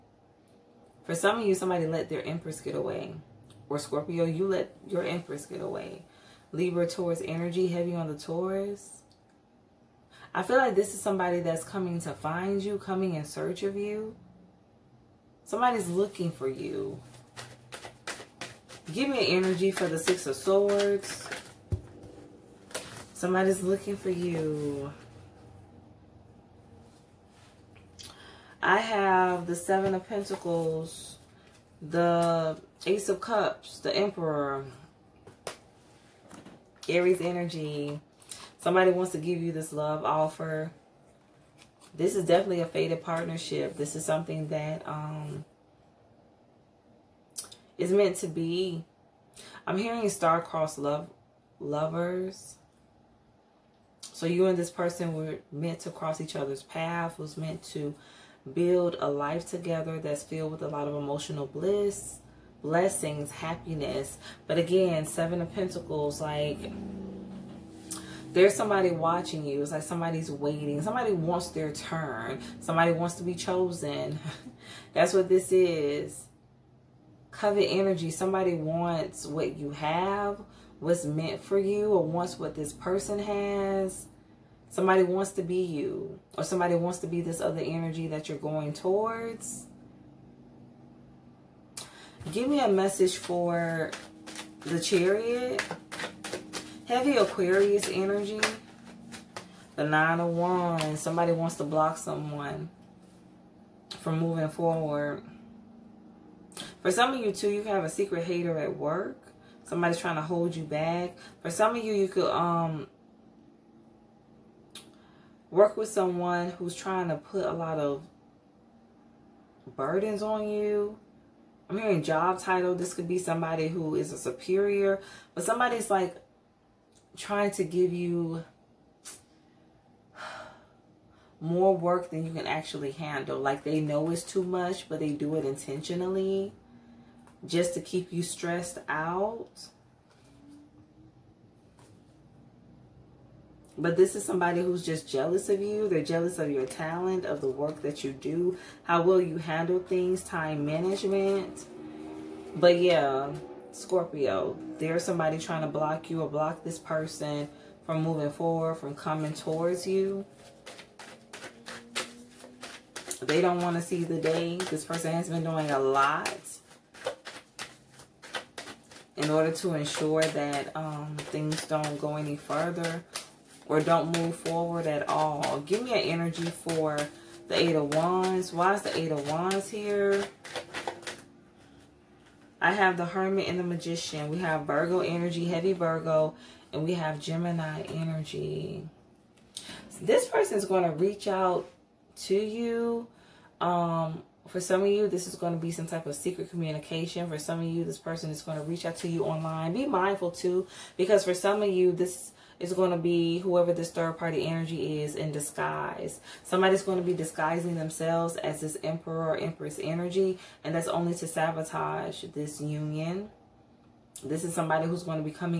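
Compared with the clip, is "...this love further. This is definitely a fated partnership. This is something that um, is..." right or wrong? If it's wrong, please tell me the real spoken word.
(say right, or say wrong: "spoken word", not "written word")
wrong: "offer", not "further".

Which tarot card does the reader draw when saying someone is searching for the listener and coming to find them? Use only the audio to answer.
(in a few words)
Six of Swords.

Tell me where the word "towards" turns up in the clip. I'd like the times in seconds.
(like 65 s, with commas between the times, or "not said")
88 s, 159 s.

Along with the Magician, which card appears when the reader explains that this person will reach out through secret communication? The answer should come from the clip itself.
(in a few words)
The Hermit.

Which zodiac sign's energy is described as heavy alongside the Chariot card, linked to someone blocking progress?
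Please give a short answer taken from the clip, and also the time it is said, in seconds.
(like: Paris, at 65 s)
Aquarius, at 97 s.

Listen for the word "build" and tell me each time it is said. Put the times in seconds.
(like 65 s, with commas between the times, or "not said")
58 s.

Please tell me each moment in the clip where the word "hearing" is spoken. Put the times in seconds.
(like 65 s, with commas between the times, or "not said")
49 s, 121 s.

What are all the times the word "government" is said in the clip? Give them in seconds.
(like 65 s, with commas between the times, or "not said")
not said.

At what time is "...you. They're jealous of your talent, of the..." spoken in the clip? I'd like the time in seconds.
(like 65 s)
145 s.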